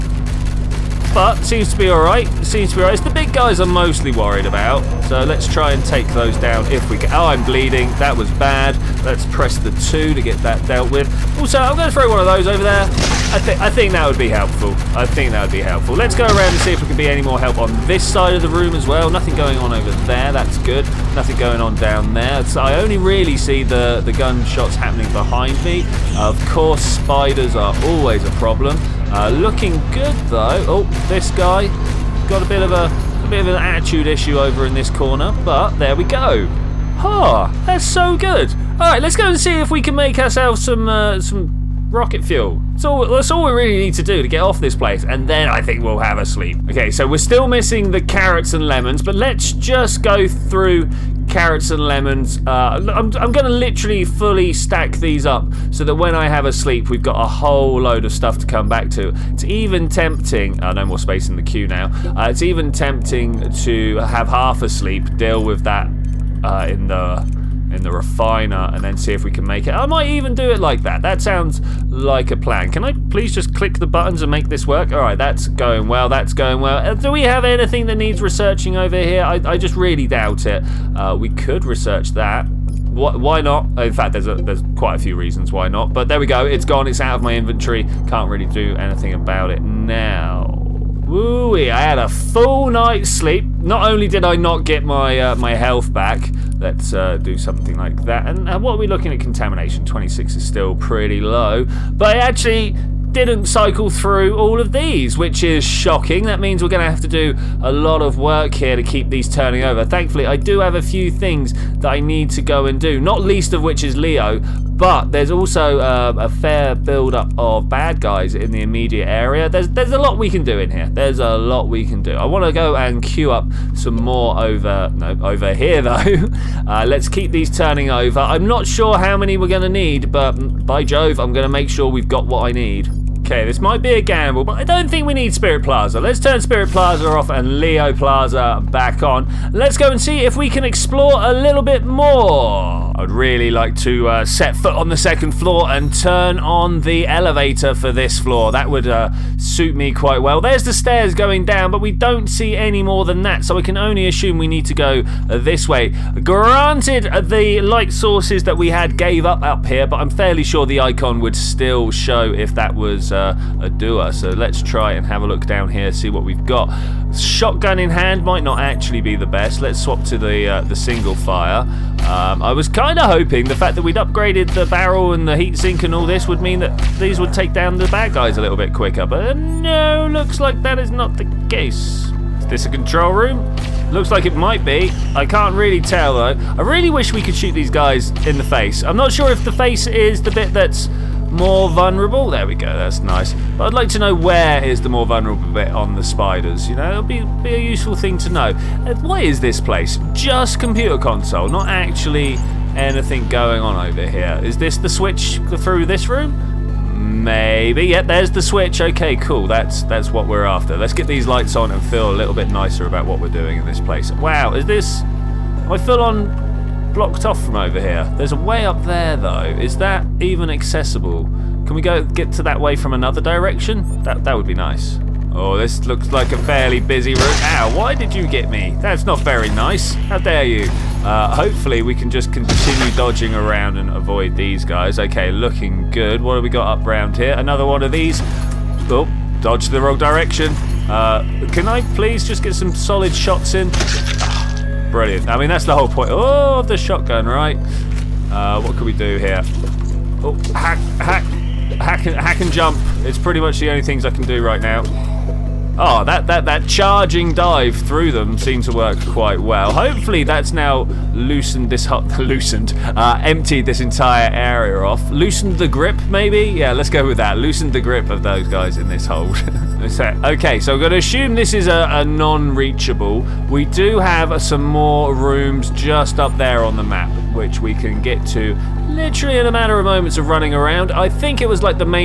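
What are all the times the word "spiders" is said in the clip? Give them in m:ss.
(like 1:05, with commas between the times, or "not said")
0:26, 3:16.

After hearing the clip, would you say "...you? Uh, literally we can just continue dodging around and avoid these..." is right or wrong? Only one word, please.
wrong.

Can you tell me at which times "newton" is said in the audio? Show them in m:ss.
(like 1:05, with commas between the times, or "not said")
not said.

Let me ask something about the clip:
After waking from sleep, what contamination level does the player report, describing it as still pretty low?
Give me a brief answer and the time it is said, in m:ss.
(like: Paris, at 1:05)
26, at 1:39.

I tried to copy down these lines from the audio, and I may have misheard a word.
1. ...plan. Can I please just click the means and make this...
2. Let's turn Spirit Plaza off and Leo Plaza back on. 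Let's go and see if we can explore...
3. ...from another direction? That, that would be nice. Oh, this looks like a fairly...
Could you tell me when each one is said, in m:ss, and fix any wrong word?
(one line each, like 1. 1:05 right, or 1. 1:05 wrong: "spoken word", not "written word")
1. 1:12 wrong: "buttons", not "means"
2. 2:15 right
3. 3:42 right.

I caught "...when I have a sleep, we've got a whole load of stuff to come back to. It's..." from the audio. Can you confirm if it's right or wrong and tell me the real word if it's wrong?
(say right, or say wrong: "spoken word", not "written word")
right.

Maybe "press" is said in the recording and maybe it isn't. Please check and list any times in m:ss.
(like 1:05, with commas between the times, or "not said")
0:09.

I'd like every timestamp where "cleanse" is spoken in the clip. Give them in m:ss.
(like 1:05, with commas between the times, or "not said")
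not said.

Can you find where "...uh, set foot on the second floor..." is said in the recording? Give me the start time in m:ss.
2:24.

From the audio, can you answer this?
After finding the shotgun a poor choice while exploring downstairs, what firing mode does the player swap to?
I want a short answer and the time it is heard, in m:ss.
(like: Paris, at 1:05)
single fire, at 2:50.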